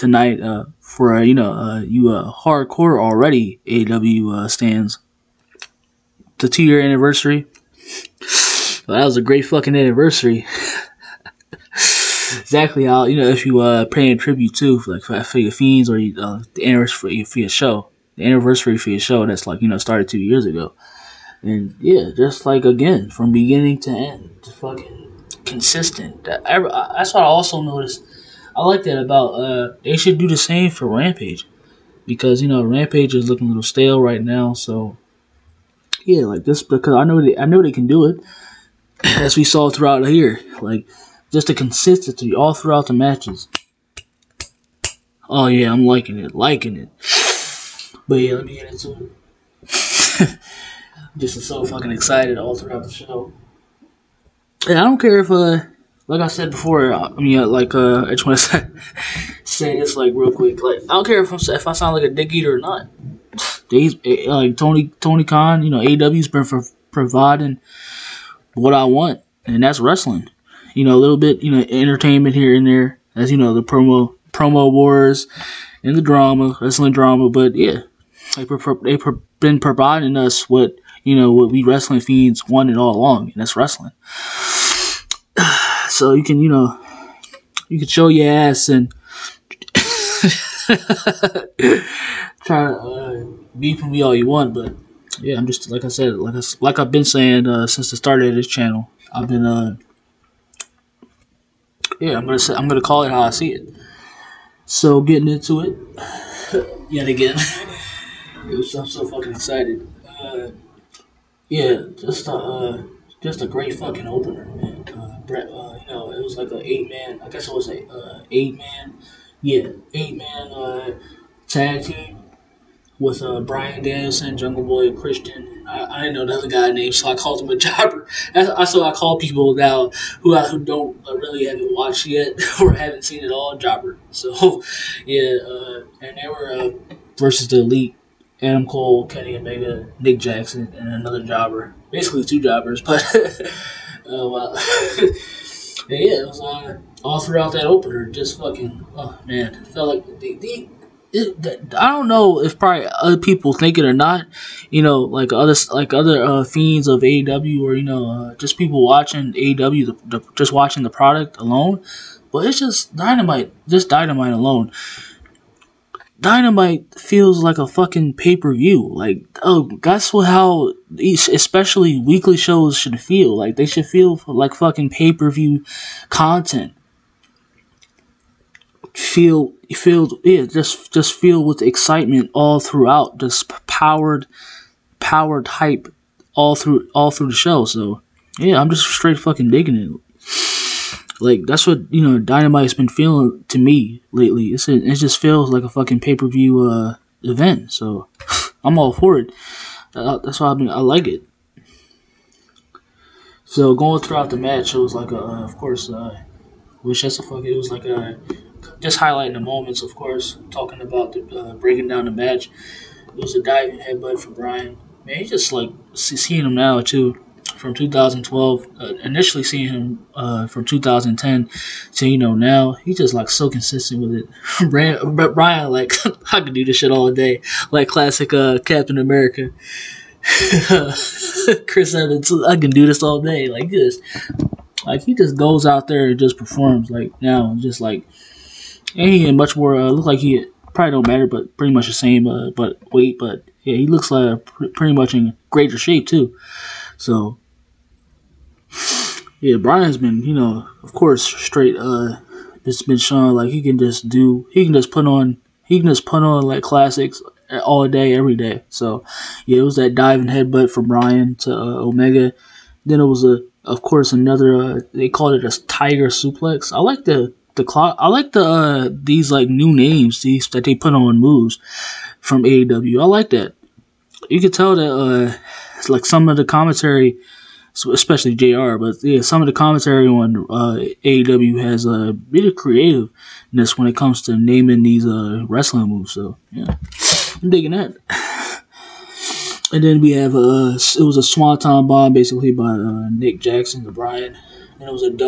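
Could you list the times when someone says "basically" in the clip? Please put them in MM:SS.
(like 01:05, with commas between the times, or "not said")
02:21, 04:52.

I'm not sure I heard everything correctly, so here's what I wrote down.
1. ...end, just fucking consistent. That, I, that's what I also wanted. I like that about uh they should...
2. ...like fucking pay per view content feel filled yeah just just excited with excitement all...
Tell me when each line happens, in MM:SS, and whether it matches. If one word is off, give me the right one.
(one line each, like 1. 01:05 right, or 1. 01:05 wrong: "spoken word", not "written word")
1. 00:23 wrong: "noticed", not "wanted"
2. 02:54 wrong: "filled", not "excited".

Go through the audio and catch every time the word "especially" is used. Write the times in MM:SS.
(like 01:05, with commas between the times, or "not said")
02:51, 04:37.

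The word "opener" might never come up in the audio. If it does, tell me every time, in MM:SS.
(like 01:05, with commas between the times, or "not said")
01:54, 02:27.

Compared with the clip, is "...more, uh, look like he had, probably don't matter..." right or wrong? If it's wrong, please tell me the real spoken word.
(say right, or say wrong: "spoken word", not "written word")
right.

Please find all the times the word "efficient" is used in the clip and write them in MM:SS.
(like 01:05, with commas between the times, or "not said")
not said.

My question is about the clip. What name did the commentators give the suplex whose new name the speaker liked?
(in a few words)
tiger suplex.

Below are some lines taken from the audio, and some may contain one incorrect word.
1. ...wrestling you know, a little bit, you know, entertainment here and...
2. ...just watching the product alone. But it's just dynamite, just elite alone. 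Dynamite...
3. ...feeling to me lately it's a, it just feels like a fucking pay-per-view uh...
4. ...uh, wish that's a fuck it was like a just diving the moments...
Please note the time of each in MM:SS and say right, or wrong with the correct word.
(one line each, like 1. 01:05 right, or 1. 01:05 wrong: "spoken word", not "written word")
1. 01:09 right
2. 02:40 wrong: "dynamite", not "elite"
3. 03:12 right
4. 03:25 wrong: "highlighting", not "diving".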